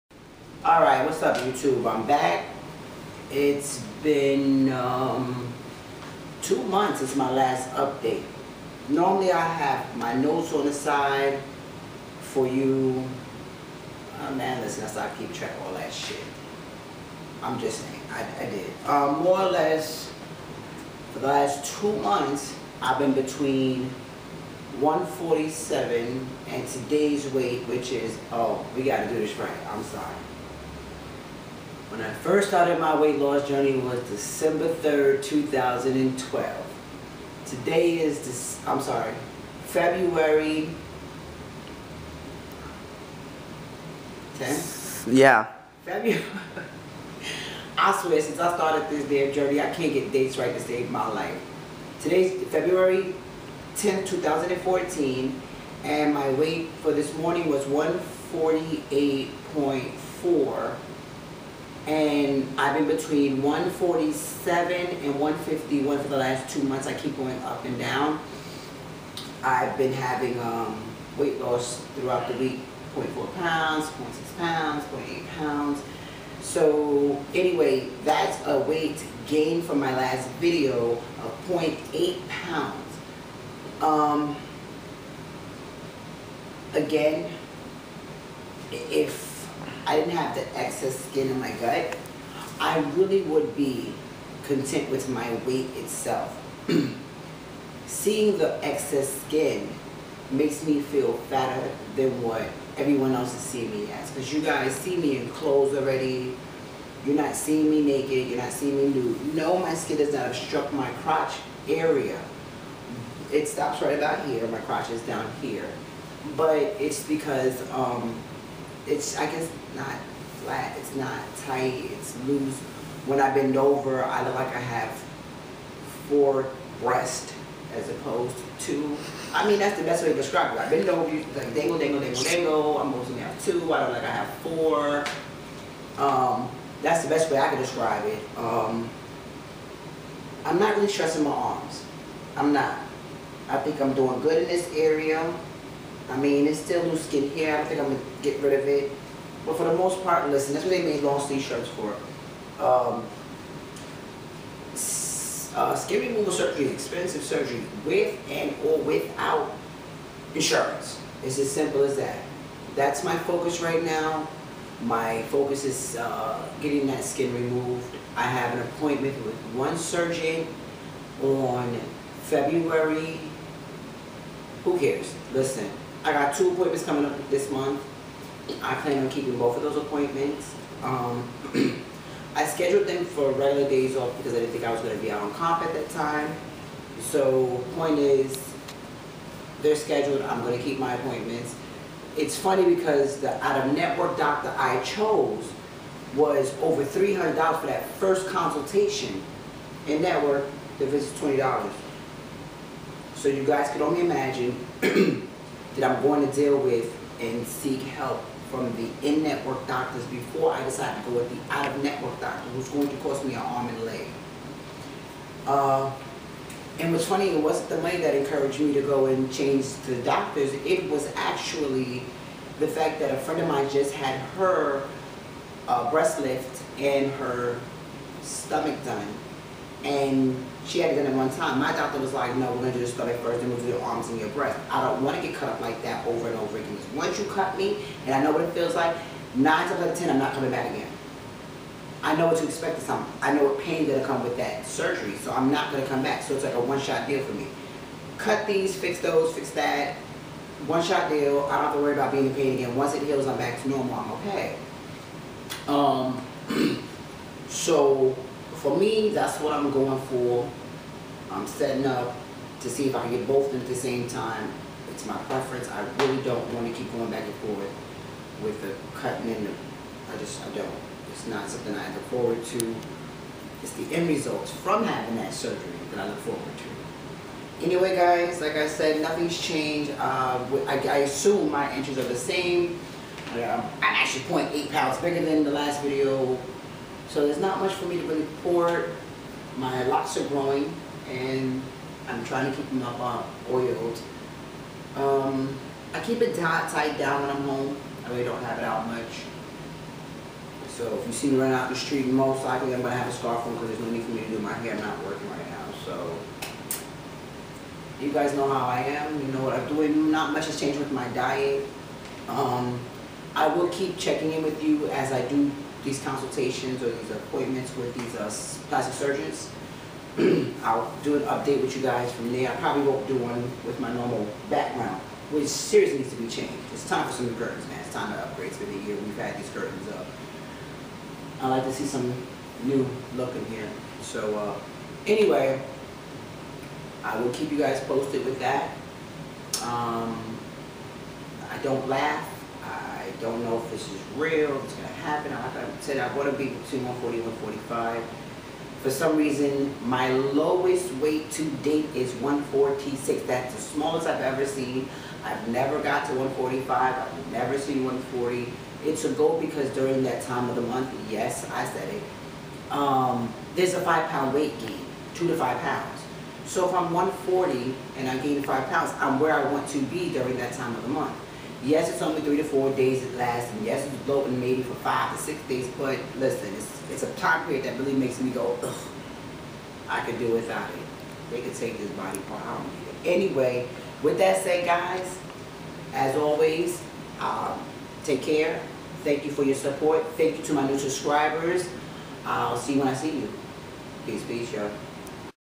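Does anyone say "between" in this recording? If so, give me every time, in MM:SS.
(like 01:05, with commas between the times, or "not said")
00:23, 01:02, 05:46.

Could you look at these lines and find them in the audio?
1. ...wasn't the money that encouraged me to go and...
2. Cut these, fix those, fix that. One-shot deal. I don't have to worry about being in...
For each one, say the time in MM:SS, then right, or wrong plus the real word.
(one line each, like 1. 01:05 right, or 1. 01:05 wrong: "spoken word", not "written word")
1. 03:37 right
2. 04:08 right.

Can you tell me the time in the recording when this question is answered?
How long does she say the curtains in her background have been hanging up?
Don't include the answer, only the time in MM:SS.
05:28.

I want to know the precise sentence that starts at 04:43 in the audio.
Uh, I'm actually 0.8 pounds bigger than the last video.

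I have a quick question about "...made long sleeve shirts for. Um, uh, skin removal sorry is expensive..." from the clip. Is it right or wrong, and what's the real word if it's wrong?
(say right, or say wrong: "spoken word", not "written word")
wrong: "surgery", not "sorry".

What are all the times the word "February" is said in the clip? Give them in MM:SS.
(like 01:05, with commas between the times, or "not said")
00:39, 00:45, 00:52, 02:52.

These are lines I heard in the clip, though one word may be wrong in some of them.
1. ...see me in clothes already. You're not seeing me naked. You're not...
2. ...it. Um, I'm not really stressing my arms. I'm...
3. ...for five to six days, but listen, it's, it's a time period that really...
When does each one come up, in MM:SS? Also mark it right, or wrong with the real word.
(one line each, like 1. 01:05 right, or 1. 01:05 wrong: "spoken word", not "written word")
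1. 01:44 right
2. 02:18 right
3. 06:14 right.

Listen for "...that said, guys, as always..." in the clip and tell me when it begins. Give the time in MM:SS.
06:24.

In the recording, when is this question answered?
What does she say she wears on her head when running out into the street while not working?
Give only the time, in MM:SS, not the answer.
05:03.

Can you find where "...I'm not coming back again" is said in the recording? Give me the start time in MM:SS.
04:00.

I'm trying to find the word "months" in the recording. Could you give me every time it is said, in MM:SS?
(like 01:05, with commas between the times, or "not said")
00:06, 00:22, 01:06, 02:57, 06:00, 06:10.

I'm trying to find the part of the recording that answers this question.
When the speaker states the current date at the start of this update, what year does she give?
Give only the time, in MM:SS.
00:54.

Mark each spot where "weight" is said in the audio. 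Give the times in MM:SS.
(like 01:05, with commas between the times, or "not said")
00:27, 00:32, 00:56, 01:11, 01:18, 01:35, 05:50, 06:04.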